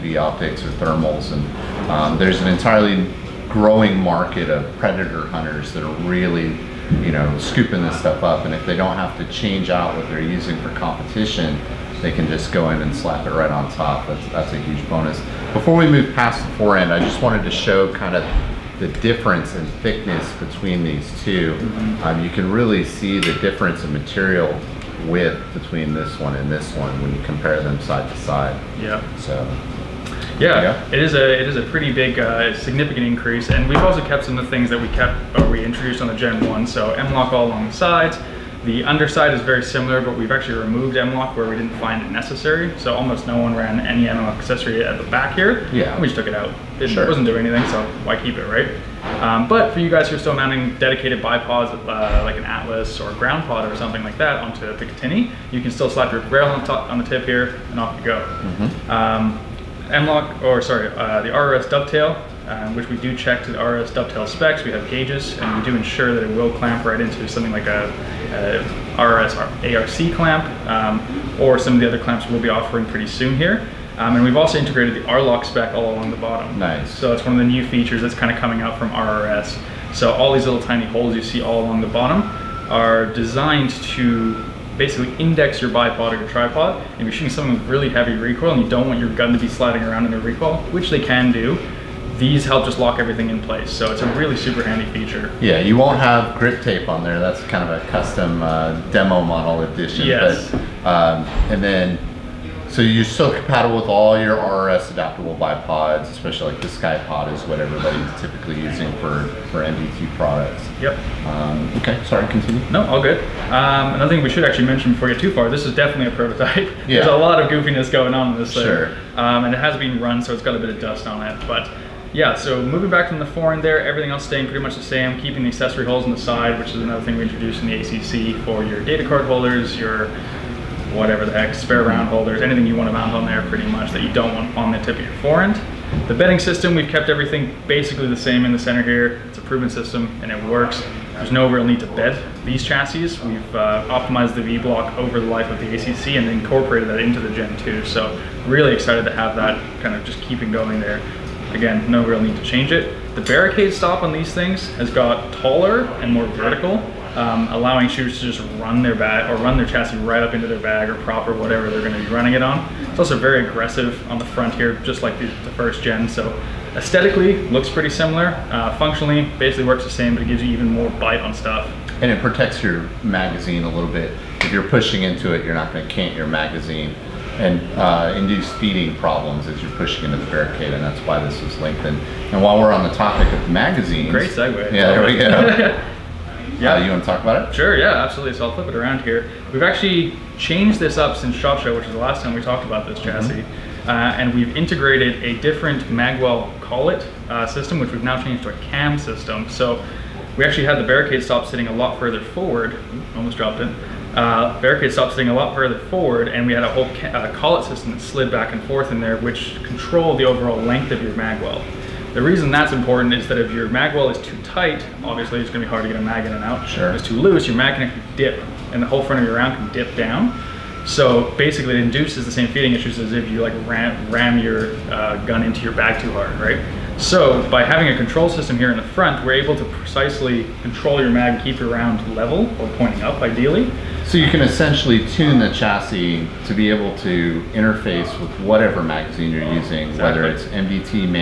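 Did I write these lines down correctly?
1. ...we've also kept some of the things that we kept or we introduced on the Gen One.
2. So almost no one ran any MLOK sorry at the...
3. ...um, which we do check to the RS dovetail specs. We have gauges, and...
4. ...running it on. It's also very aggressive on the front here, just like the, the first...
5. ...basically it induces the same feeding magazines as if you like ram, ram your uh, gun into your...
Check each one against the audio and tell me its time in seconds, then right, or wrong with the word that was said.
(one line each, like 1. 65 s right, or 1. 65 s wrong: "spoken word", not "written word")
1. 33 s right
2. 42 s wrong: "accessory", not "sorry"
3. 62 s right
4. 162 s right
5. 221 s wrong: "issues", not "magazines".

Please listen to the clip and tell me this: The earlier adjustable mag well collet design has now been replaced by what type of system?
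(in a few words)
A cam system.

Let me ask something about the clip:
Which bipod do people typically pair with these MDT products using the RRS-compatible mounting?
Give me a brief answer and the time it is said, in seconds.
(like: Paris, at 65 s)
SkyPod, at 106 s.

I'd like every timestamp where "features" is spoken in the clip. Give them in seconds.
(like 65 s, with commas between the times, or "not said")
77 s, 94 s.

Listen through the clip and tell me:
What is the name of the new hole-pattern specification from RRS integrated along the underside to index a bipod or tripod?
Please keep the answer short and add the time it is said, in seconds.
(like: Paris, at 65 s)
R-Lock, at 75 s.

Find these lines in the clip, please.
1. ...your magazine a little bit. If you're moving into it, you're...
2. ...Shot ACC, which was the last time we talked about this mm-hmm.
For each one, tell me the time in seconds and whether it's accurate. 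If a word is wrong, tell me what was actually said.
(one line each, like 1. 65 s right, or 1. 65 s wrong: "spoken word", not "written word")
1. 172 s wrong: "pushing", not "moving"
2. 191 s wrong: "Show", not "ACC".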